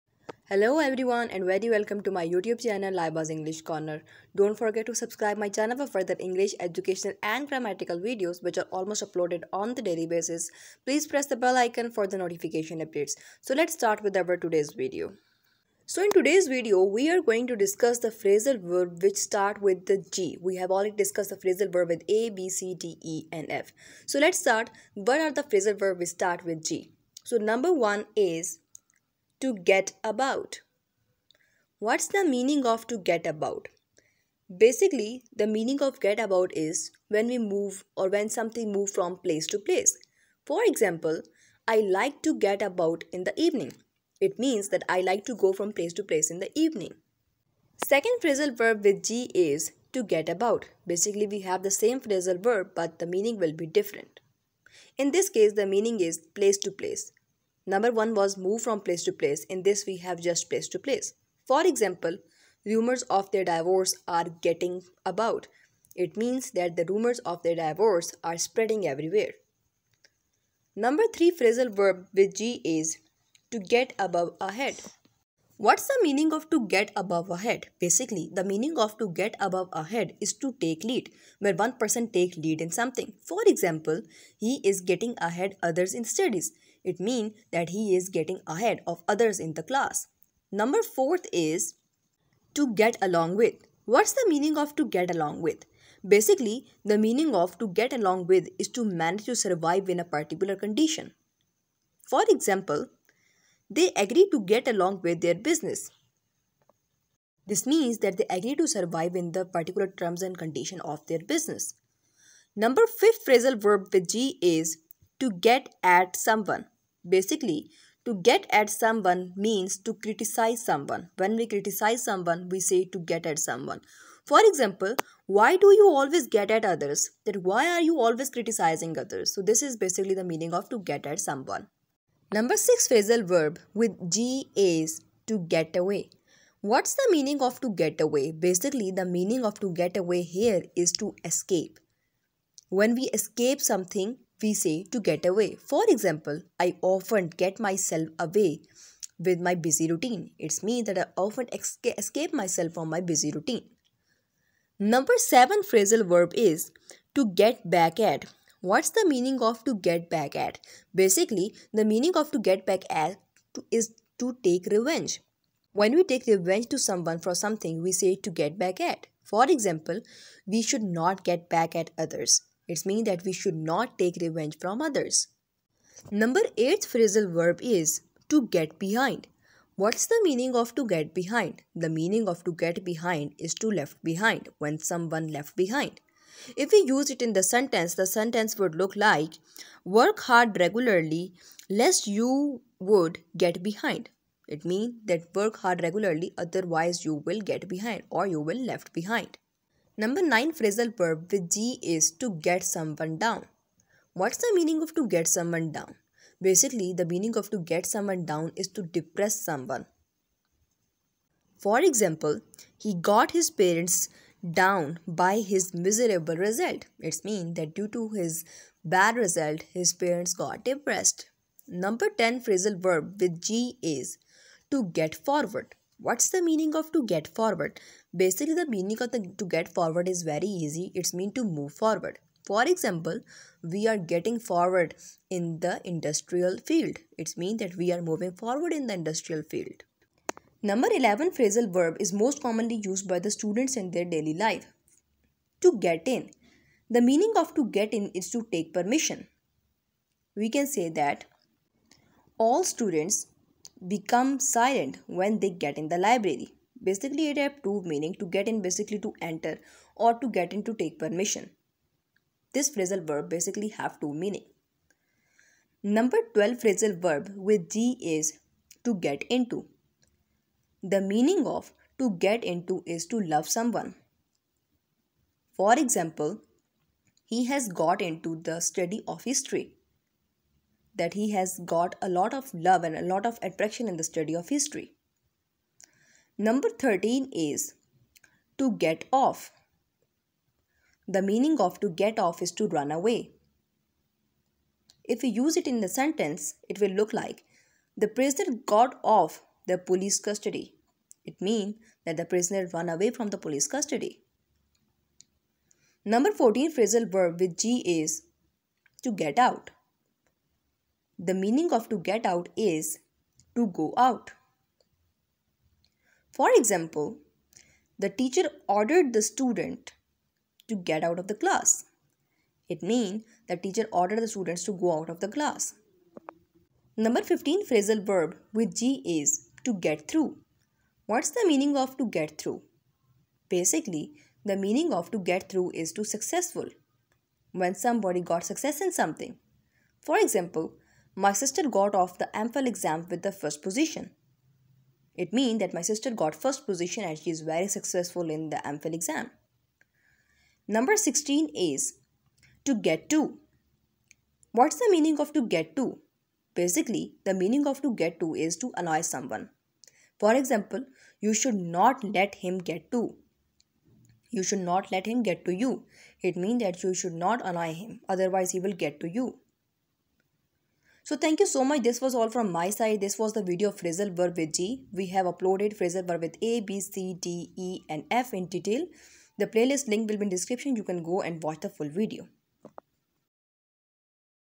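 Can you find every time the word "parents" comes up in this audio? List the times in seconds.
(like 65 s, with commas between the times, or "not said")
213 s, 219 s.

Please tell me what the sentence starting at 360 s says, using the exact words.
For example, you should not let him get to.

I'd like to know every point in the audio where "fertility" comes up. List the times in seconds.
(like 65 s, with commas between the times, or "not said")
not said.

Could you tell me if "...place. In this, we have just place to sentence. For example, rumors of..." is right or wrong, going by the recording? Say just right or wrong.
wrong.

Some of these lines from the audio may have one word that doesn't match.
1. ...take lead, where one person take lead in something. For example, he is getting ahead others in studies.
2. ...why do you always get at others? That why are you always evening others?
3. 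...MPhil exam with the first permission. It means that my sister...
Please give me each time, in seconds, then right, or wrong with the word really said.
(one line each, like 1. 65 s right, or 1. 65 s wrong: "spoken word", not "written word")
1. 80 s right
2. 125 s wrong: "criticizing", not "evening"
3. 342 s wrong: "position", not "permission".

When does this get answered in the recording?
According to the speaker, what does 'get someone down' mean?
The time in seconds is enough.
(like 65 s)
208 s.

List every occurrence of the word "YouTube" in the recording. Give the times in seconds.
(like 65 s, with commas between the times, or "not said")
2 s.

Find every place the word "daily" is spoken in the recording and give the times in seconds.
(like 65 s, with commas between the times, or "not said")
9 s, 244 s.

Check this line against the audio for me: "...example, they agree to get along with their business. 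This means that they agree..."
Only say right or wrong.
right.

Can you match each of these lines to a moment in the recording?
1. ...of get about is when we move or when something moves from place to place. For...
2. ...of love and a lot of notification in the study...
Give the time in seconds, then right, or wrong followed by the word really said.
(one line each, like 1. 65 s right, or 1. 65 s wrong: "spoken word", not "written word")
1. 35 s right
2. 282 s wrong: "attraction", not "notification".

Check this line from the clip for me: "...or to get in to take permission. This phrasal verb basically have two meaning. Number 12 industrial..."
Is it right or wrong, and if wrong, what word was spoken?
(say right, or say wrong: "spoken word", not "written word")
wrong: "phrasal", not "industrial".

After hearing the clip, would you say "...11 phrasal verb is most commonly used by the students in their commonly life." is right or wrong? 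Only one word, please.
wrong.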